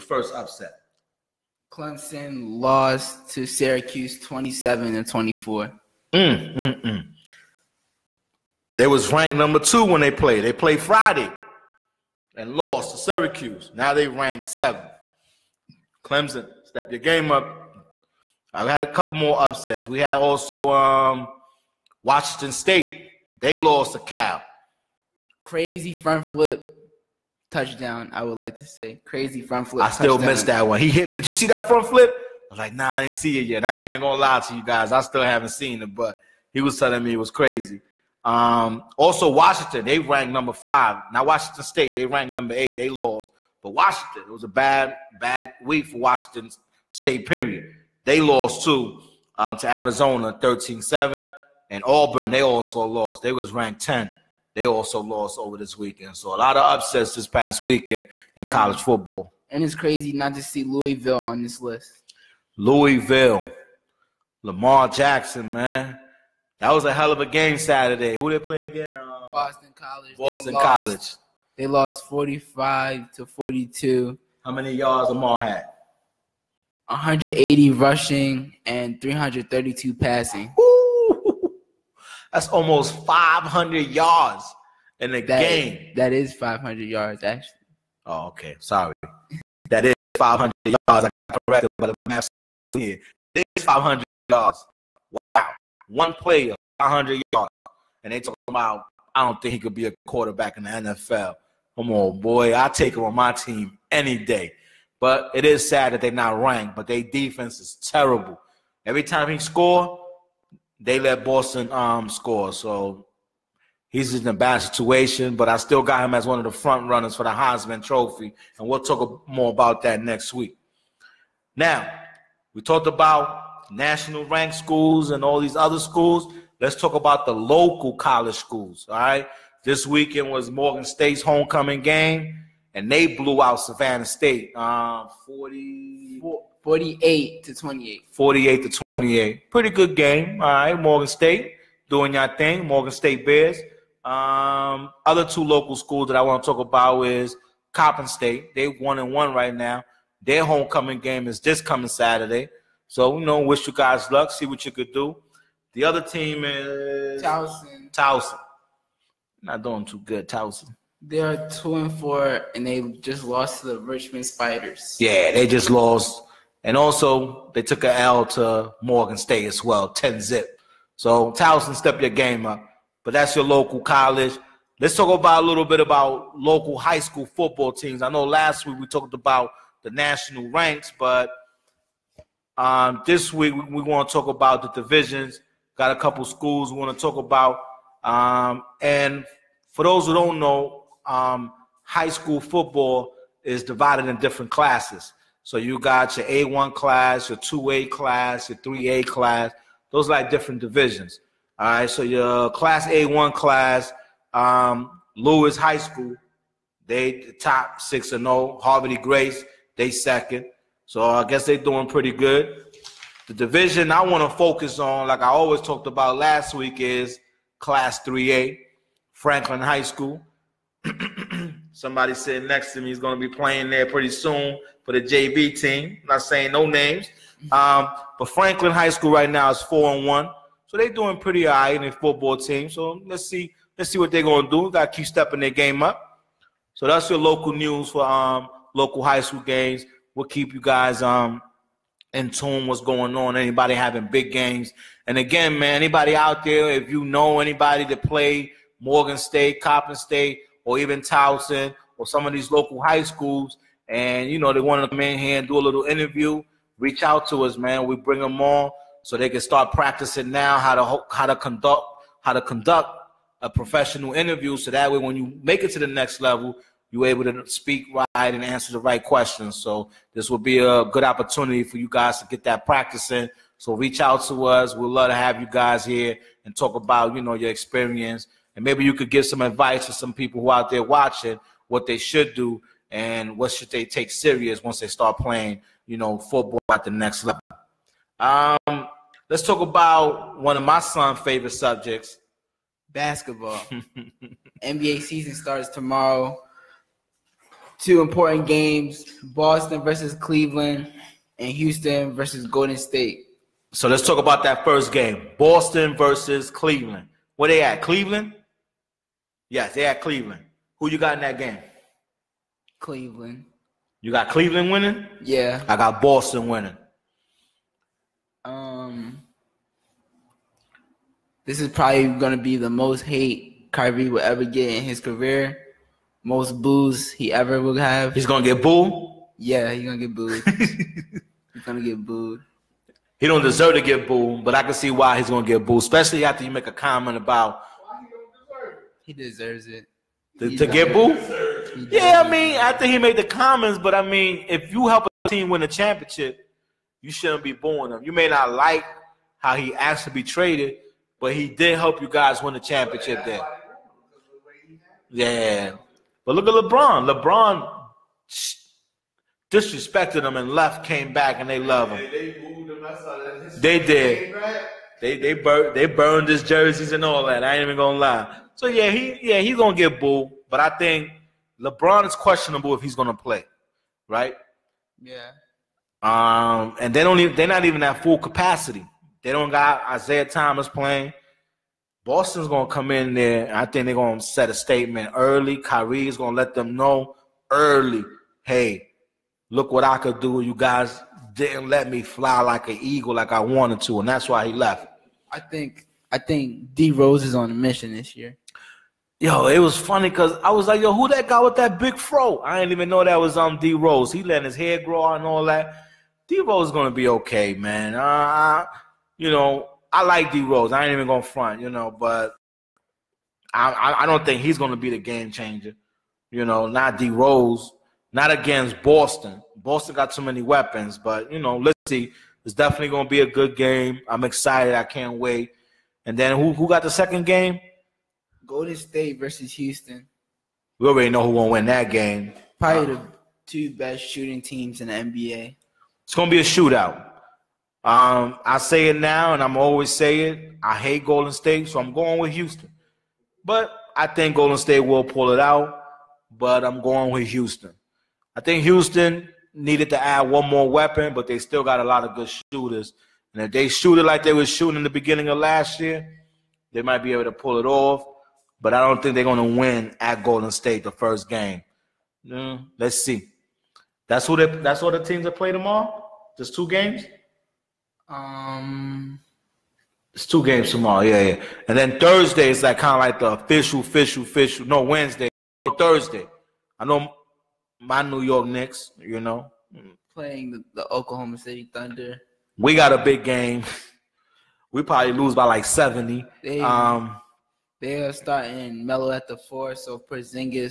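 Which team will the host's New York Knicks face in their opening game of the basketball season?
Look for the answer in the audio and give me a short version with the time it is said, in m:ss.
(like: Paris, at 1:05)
Oklahoma City Thunder, at 8:00.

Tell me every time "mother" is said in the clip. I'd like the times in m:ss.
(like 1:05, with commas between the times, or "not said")
not said.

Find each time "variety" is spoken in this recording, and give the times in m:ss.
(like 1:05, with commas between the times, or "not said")
not said.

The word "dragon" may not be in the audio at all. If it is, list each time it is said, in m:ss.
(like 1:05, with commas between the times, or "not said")
not said.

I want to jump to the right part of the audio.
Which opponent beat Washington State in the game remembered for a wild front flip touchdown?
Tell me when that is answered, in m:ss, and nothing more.
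0:23.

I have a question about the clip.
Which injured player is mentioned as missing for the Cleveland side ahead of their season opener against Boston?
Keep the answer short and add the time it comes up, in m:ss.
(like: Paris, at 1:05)
Isaiah Thomas, at 6:19.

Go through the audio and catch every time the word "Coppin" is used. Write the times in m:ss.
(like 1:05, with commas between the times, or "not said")
2:27, 4:09.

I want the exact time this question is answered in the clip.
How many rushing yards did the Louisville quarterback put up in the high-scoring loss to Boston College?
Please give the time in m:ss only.
1:16.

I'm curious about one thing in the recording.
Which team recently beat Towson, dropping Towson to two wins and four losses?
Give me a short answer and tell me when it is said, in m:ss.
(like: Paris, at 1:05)
Richmond Spiders, at 2:43.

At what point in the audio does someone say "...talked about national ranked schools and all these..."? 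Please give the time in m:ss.
2:02.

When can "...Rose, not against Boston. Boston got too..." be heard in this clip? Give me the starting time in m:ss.
6:57.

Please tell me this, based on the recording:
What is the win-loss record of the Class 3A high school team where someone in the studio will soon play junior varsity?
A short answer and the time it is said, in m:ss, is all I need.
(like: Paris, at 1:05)
4 and 1, at 3:49.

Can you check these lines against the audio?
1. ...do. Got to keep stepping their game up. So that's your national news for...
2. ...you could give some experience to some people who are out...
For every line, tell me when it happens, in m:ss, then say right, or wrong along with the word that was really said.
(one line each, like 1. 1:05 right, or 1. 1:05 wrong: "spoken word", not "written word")
1. 3:54 wrong: "local", not "national"
2. 4:38 wrong: "advice", not "experience".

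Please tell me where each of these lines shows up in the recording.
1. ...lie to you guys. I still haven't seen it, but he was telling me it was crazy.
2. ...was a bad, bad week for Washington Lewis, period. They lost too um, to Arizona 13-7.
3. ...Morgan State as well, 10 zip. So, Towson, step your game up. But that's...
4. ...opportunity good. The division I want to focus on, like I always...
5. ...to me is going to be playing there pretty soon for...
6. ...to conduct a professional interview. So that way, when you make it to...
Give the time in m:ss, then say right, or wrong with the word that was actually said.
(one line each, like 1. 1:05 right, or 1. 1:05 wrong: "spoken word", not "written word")
1. 0:34 right
2. 0:44 wrong: "State", not "Lewis"
3. 2:48 right
4. 3:31 wrong: "pretty", not "opportunity"
5. 3:42 right
6. 4:22 right.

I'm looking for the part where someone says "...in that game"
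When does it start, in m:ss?
5:11.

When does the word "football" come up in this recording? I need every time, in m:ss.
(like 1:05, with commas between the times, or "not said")
0:58, 2:57, 3:12, 3:51, 4:46.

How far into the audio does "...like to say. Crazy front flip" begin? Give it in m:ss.
0:28.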